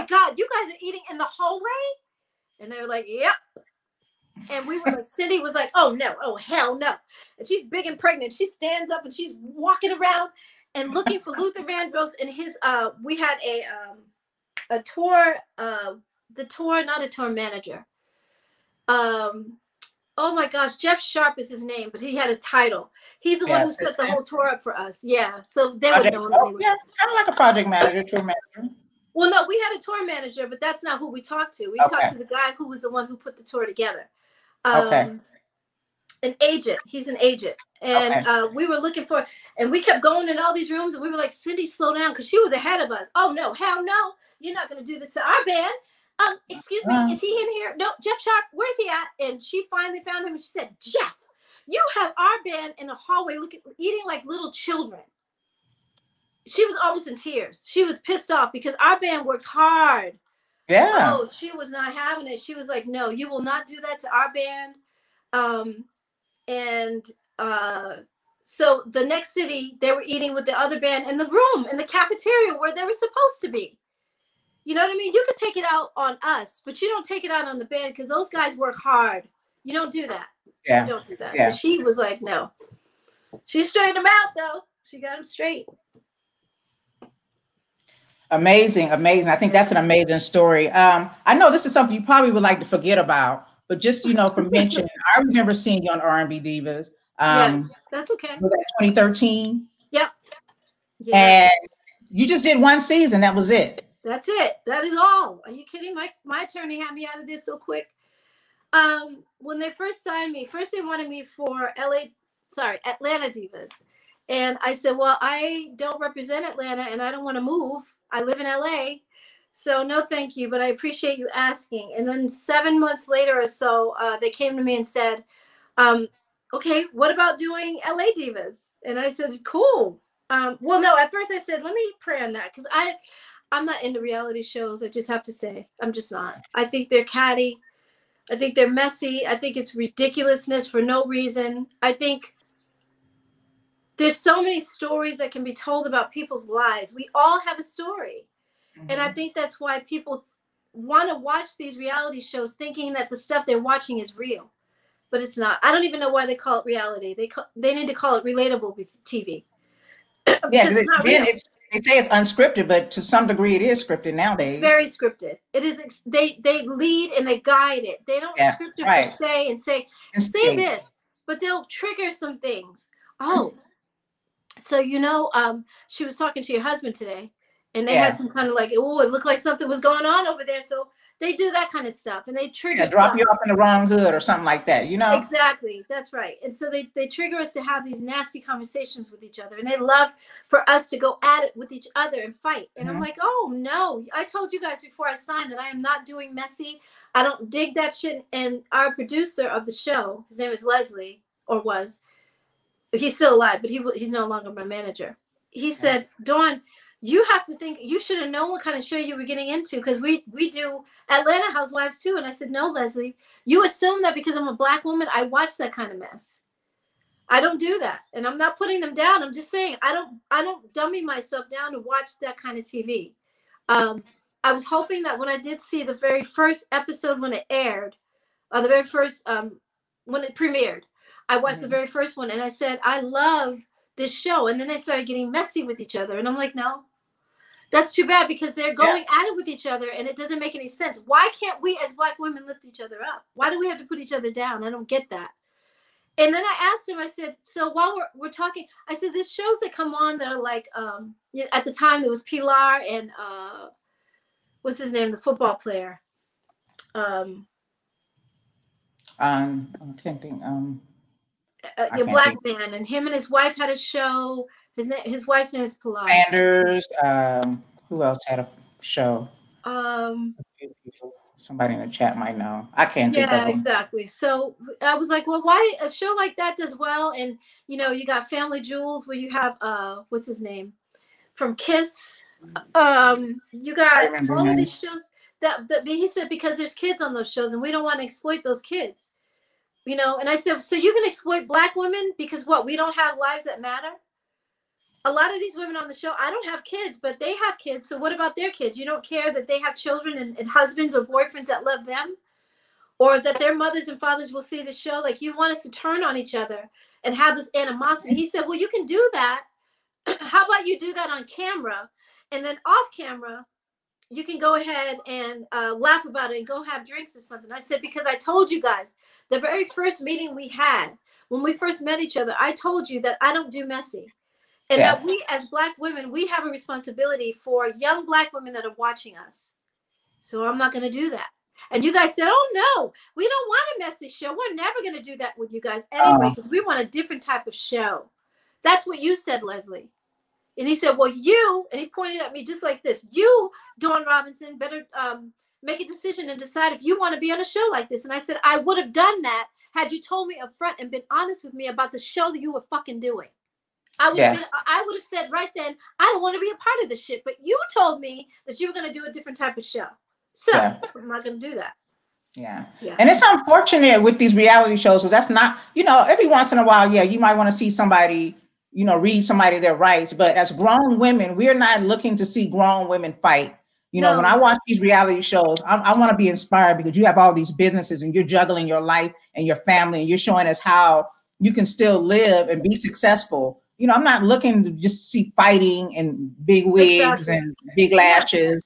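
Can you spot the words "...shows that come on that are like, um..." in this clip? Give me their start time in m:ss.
4:09.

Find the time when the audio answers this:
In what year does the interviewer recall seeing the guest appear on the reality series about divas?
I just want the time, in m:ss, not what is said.
1:38.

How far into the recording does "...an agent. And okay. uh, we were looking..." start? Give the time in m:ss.
0:37.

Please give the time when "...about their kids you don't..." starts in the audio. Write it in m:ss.
4:58.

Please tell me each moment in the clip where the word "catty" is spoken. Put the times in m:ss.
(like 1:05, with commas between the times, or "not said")
2:17.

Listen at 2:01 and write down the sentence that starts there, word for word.
And then seven months later or so, uh, they came to me and said, um, okay, what about doing LA Divas?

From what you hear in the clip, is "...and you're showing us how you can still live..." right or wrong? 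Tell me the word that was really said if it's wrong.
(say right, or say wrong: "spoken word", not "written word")
right.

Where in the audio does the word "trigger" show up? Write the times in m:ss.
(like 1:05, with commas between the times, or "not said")
2:51, 3:02, 3:07.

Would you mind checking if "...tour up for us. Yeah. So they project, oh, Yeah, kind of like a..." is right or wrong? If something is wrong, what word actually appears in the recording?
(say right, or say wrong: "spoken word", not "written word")
right.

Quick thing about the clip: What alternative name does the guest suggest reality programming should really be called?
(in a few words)
relatable TV.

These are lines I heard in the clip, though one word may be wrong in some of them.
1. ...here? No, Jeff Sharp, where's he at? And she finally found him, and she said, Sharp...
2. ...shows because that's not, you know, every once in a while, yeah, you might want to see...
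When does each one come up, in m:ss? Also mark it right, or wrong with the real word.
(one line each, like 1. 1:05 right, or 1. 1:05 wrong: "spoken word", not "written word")
1. 0:47 wrong: "Jeff", not "Sharp"
2. 6:04 right.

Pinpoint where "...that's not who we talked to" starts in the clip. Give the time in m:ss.
0:30.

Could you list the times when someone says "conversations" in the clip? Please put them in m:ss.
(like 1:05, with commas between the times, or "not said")
3:08.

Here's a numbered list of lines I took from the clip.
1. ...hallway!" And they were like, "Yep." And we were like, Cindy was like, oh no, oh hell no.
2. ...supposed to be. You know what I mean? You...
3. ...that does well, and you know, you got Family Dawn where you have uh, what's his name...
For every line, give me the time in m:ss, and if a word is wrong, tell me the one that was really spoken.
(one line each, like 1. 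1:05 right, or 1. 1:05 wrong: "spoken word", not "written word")
1. 0:01 right
2. 1:12 right
3. 4:36 wrong: "Jewels", not "Dawn".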